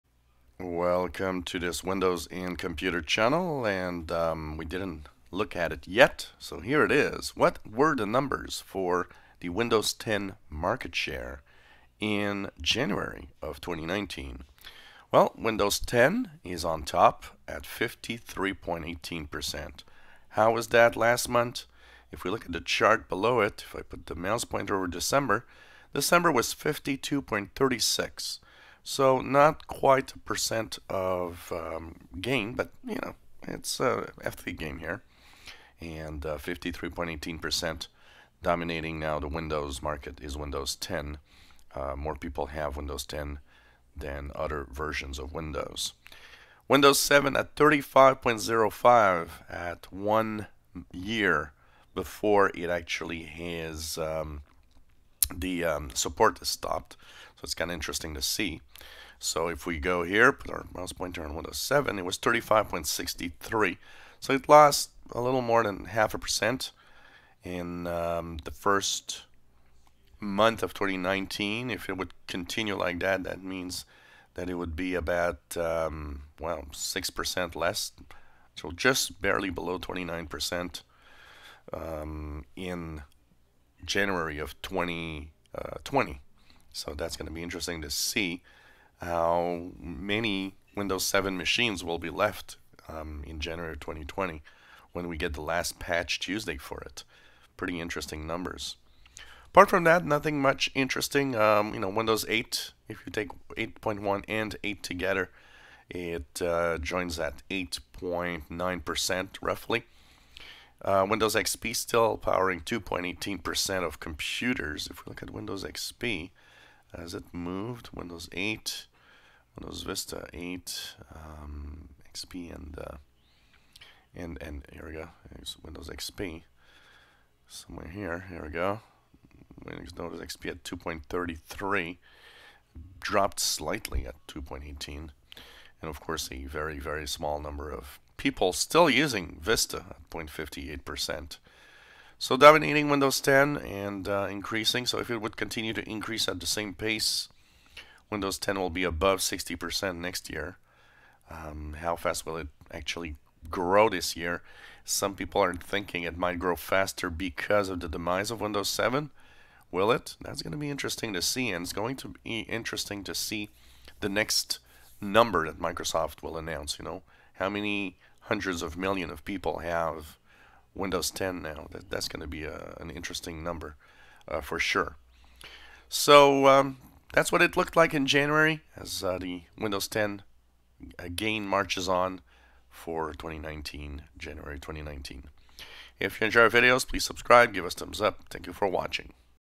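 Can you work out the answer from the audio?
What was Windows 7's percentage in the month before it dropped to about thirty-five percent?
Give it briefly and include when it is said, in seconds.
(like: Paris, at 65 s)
35.63%, at 62 s.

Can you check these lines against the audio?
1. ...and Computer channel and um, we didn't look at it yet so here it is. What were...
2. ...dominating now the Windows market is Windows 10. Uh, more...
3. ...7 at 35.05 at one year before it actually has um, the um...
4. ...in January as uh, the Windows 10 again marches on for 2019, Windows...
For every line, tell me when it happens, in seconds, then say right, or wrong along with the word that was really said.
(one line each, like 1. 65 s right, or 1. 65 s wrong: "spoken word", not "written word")
1. 2 s right
2. 38 s right
3. 46 s right
4. 177 s wrong: "January", not "Windows".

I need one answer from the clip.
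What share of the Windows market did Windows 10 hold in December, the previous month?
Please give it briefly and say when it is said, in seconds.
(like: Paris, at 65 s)
52.36%, at 26 s.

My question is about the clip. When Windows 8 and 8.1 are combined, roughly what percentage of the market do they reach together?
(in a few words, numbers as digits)
8.9%.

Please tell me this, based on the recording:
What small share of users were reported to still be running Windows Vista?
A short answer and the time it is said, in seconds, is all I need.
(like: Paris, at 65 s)
0.58%, at 140 s.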